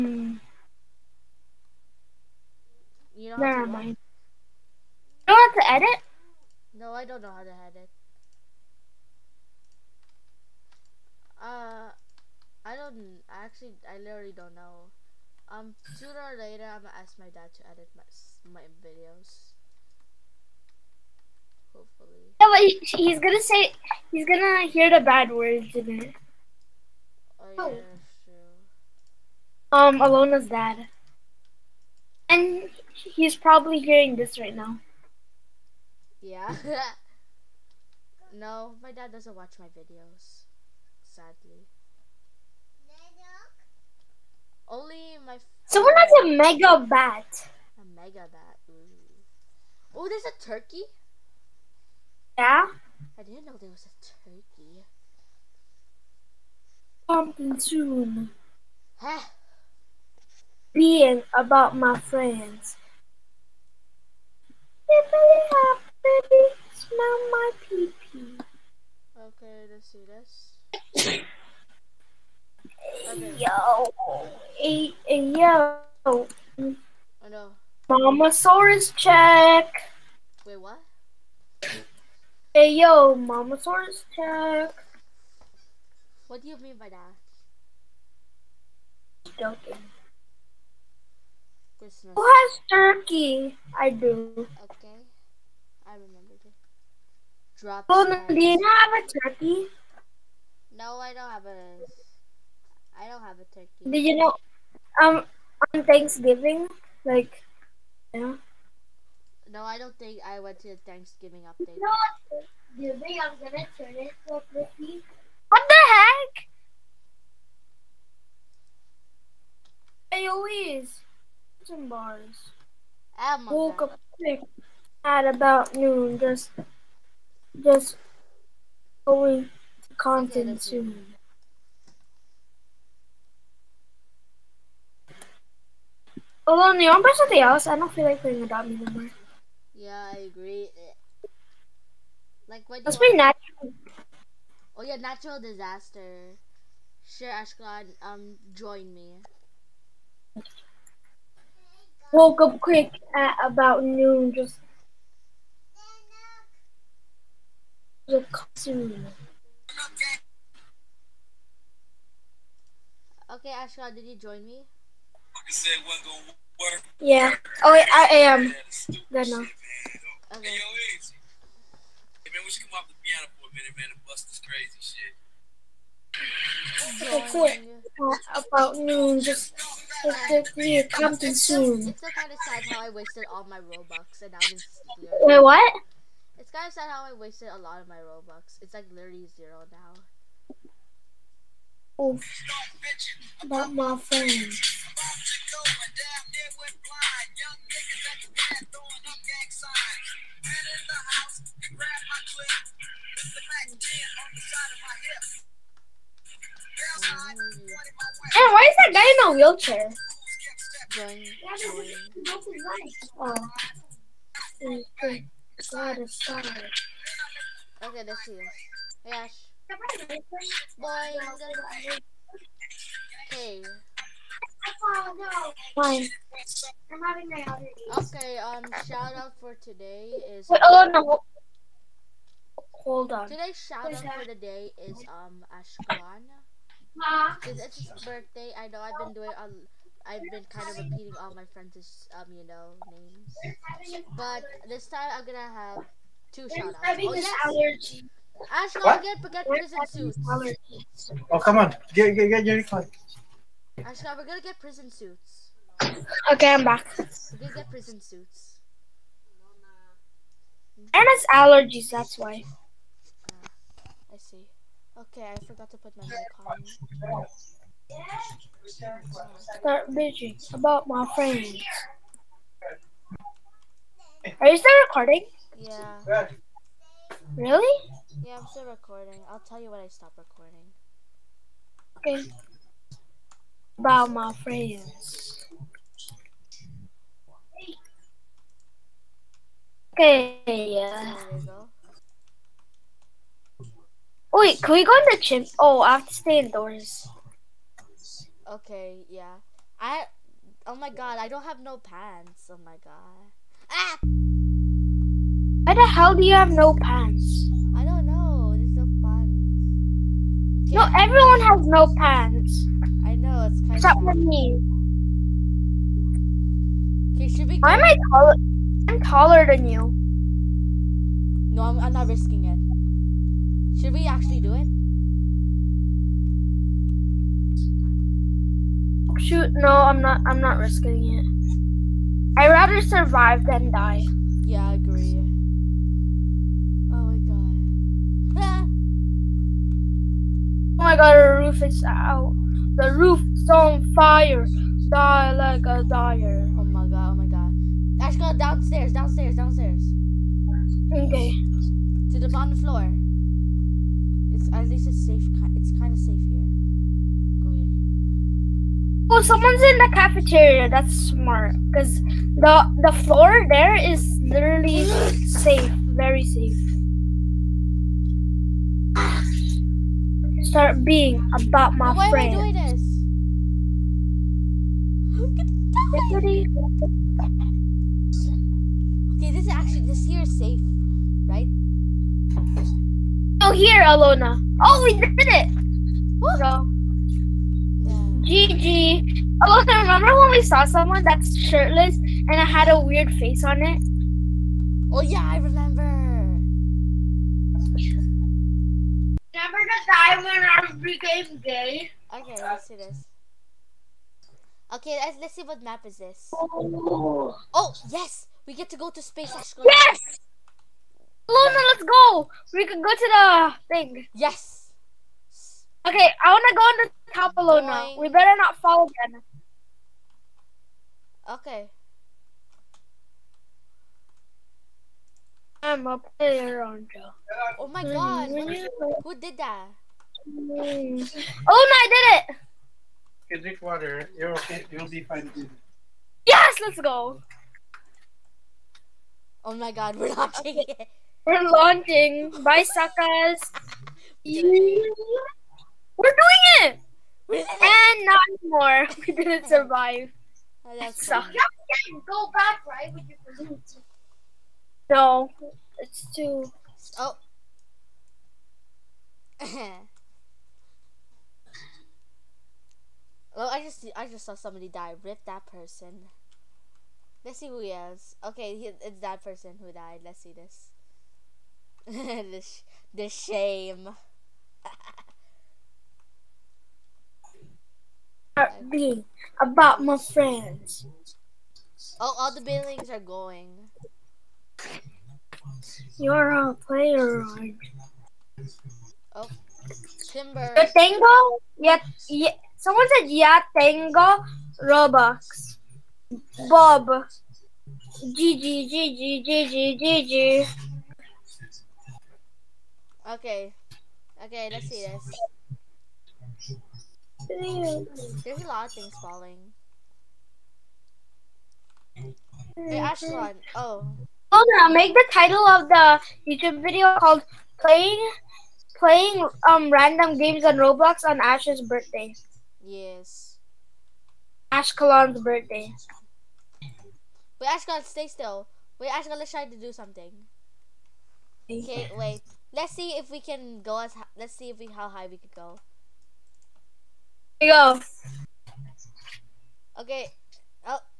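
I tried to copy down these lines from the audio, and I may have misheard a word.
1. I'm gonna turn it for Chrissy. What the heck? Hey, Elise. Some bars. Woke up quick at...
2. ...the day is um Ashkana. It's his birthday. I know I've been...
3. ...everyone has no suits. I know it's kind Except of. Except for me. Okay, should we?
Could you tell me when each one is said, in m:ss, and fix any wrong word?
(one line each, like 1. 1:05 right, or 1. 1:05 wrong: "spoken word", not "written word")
1. 1:53 right
2. 3:54 right
3. 5:10 wrong: "pants", not "suits".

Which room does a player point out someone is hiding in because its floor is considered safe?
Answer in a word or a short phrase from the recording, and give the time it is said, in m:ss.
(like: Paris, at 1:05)
Cafeteria, at 5:59.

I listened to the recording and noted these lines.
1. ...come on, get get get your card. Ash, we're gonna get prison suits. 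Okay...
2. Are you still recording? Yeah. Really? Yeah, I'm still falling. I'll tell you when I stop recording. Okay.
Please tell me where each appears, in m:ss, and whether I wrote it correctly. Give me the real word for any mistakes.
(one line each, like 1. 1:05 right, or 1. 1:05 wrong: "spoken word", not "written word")
1. 4:11 right
2. 4:34 wrong: "recording", not "falling".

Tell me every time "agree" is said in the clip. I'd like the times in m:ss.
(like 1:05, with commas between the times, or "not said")
2:20, 5:34.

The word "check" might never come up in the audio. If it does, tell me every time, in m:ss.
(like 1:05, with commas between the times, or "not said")
1:18, 1:24.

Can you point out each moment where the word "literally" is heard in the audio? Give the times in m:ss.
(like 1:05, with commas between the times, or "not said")
0:13, 3:08, 6:04.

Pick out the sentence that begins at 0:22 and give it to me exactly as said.
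but he's gonna say he's gonna hear the bad words in it.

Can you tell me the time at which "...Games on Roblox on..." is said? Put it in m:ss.
8:40.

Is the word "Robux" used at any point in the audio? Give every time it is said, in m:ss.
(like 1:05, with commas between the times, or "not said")
3:03, 3:07, 8:14.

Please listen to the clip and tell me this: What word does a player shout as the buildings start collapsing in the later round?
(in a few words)
Timber.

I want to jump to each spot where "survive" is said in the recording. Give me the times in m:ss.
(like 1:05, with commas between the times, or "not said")
5:32, 7:29.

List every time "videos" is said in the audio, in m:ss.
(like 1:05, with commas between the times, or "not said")
0:18, 0:39, 8:36.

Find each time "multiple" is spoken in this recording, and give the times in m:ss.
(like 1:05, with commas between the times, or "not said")
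not said.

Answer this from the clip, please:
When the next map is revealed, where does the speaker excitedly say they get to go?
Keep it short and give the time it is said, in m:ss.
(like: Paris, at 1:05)
Space, at 6:49.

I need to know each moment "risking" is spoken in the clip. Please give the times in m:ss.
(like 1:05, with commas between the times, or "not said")
5:22, 5:30.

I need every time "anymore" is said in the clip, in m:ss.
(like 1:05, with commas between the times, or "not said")
2:18, 7:28.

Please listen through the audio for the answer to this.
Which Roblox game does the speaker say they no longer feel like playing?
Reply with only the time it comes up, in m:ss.
2:18.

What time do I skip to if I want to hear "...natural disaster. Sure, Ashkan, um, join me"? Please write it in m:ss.
2:25.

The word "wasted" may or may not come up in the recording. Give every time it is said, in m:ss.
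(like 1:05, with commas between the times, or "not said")
3:02, 3:07.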